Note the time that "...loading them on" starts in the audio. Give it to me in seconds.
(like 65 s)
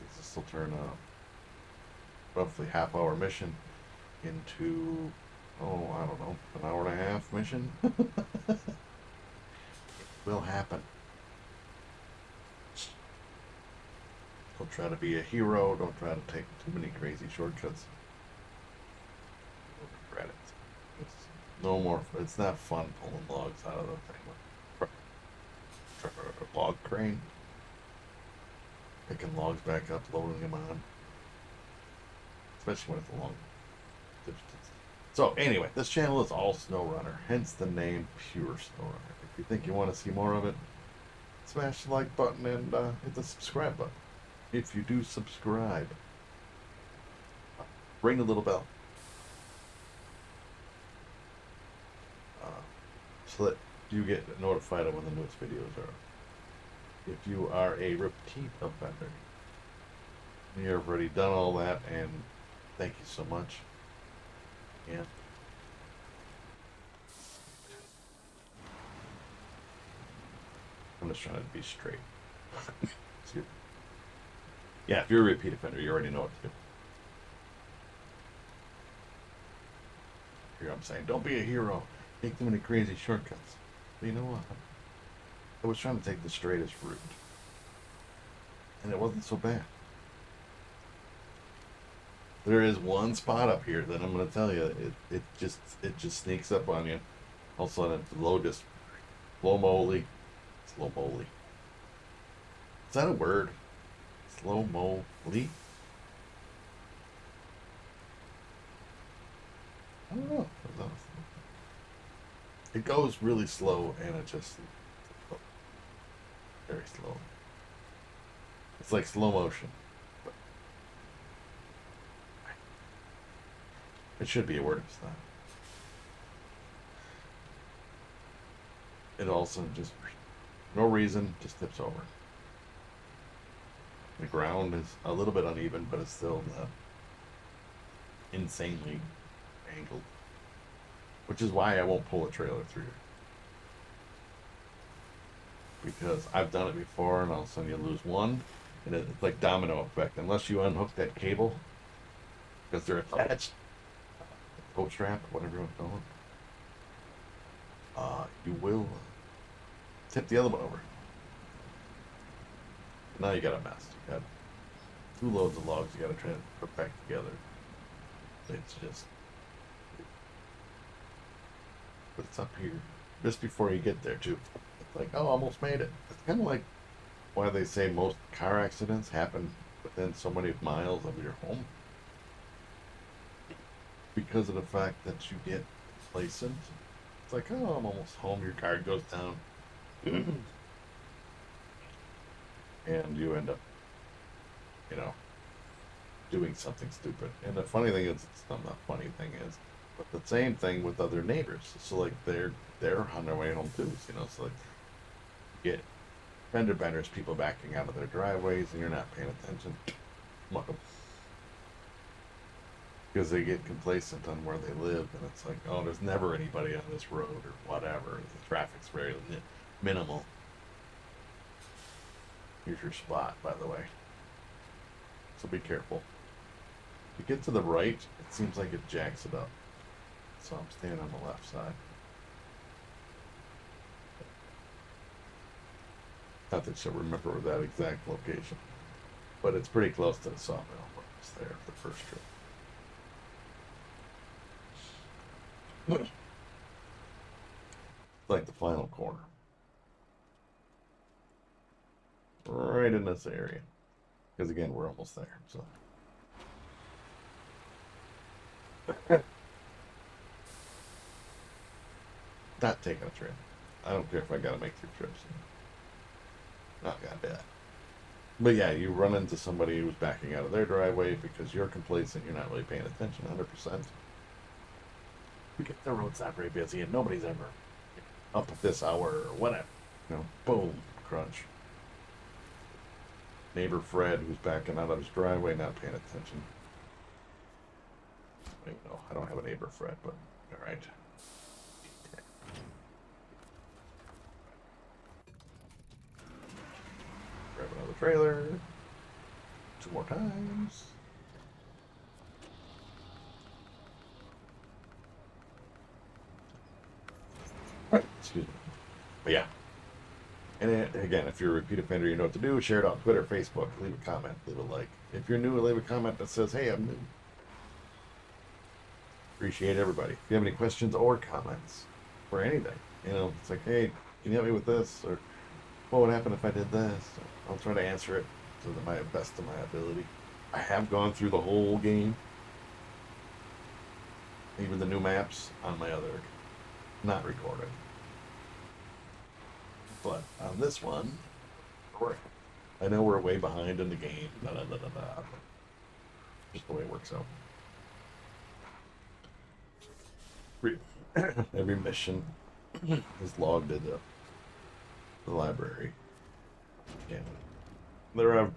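30 s.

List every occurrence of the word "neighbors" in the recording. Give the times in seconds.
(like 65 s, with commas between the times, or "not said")
201 s, 283 s, 289 s.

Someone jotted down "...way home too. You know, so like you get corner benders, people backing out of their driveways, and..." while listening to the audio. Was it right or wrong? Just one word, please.
wrong.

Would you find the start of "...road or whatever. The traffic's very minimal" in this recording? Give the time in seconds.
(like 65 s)
217 s.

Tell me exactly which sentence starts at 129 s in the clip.
It also just, no reason, just tips over.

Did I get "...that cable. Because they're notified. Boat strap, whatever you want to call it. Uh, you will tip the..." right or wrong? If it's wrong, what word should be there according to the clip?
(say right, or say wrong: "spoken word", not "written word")
wrong: "attached", not "notified".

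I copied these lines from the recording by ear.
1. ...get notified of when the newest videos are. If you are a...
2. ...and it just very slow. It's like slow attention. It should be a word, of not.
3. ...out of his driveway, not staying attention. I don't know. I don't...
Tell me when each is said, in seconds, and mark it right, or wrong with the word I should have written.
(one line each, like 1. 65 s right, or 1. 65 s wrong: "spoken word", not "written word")
1. 54 s right
2. 114 s wrong: "motion", not "attention"
3. 284 s wrong: "paying", not "staying".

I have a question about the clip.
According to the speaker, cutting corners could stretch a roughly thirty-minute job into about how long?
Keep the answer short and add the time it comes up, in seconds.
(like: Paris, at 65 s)
an hour and a half, at 6 s.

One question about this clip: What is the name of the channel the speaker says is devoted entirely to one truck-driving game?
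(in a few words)
Pure SnowRunner.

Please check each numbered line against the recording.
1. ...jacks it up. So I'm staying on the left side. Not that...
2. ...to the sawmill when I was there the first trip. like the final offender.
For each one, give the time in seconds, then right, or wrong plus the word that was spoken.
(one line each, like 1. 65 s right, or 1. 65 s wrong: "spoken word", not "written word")
1. 228 s right
2. 240 s wrong: "corner", not "offender".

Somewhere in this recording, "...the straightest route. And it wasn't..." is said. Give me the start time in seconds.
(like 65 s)
86 s.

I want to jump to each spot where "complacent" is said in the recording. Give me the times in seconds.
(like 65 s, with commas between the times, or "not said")
186 s, 213 s, 271 s.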